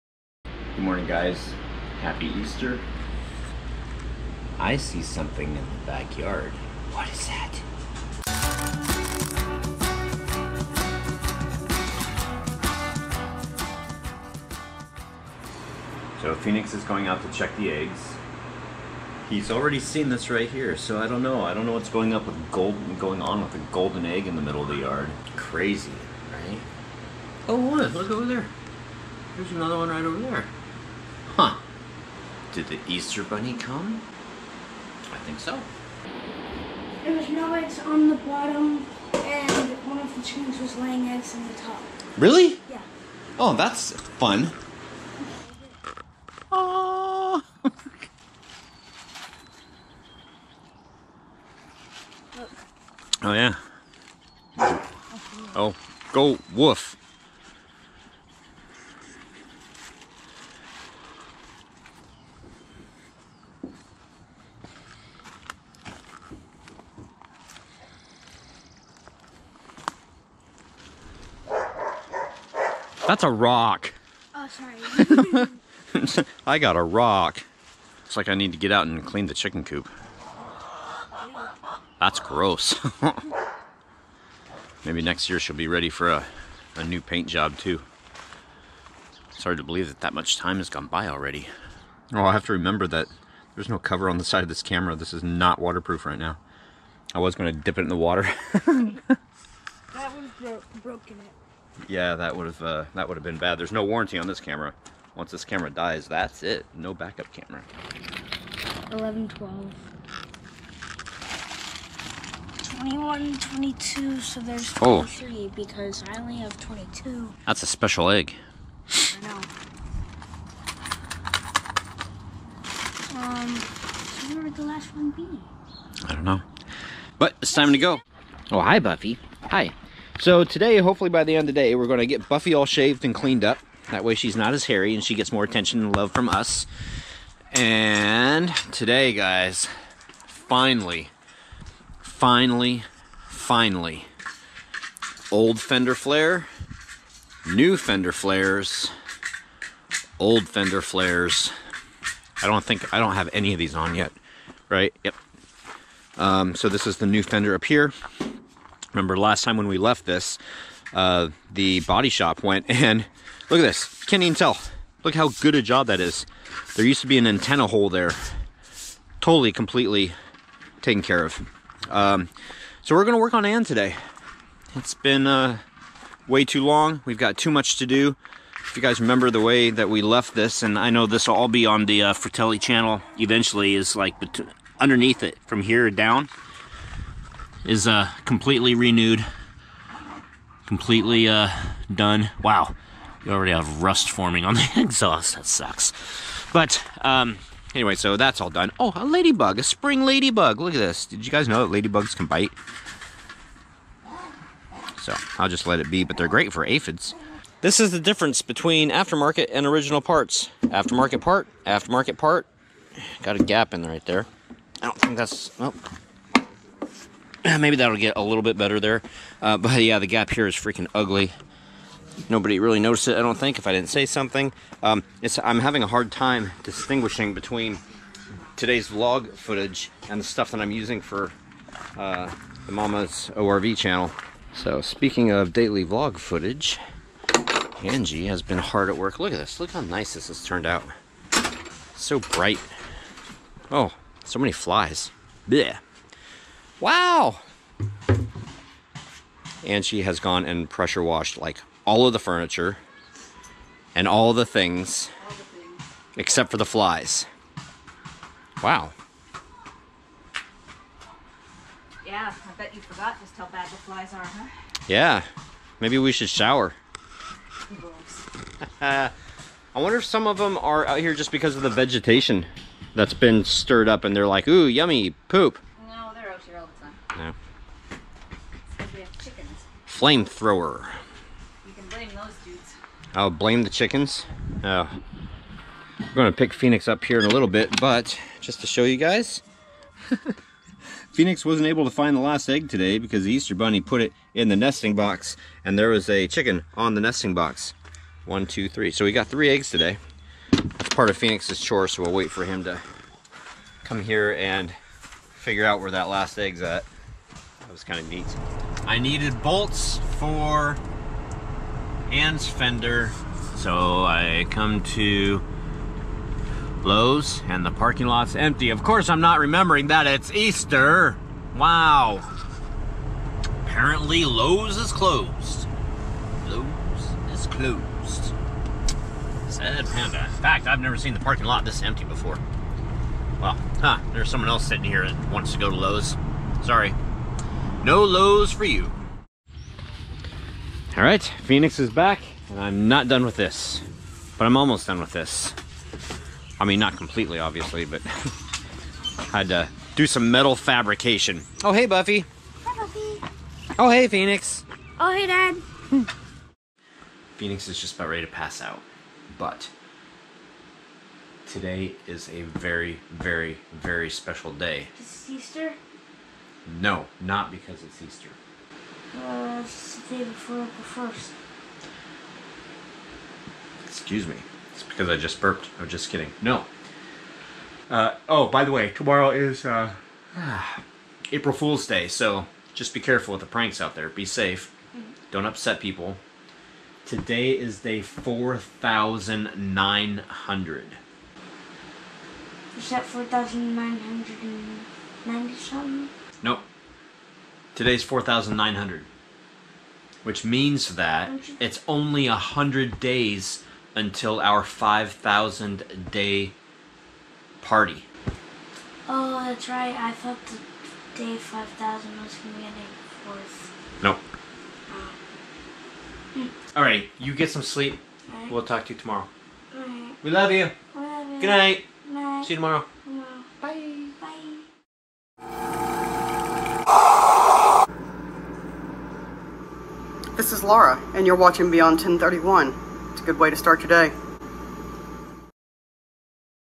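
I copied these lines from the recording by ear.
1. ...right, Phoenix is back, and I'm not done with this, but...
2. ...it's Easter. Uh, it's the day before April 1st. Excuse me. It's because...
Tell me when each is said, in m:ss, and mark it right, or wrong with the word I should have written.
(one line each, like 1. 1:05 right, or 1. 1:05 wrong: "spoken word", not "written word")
1. 5:41 right
2. 6:07 right.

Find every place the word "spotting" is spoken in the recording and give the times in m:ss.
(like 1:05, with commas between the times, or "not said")
not said.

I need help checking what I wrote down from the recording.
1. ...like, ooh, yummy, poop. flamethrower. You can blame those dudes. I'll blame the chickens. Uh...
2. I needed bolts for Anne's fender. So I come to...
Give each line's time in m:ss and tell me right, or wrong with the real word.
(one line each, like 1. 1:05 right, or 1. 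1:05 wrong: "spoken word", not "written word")
1. 4:34 right
2. 5:08 right.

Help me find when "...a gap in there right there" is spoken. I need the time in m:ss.
3:33.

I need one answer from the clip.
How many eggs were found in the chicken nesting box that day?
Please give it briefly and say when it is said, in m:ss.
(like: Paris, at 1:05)
3, at 4:59.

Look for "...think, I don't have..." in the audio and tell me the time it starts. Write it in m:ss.
2:32.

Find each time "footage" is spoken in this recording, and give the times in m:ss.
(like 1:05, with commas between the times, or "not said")
3:49, 3:56.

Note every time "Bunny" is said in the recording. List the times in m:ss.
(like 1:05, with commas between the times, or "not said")
0:33, 4:53.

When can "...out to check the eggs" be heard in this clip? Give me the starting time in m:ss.
0:17.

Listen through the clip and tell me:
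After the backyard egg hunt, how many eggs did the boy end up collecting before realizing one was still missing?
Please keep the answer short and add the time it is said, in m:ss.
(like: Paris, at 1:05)
22, at 1:56.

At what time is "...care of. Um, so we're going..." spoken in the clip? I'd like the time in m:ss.
2:51.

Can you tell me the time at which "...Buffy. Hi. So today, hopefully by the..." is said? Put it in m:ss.
2:08.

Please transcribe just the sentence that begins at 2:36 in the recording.
Um, so this is the new fender up here.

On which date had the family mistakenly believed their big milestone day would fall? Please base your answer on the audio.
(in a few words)
April 4th.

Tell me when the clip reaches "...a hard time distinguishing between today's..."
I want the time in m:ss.
3:45.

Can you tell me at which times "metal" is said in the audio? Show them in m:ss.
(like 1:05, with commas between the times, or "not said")
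5:50.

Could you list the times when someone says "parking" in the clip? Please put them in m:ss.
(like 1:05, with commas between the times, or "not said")
5:17, 5:31.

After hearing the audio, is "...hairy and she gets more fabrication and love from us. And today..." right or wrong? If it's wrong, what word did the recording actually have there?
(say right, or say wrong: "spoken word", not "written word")
wrong: "attention", not "fabrication".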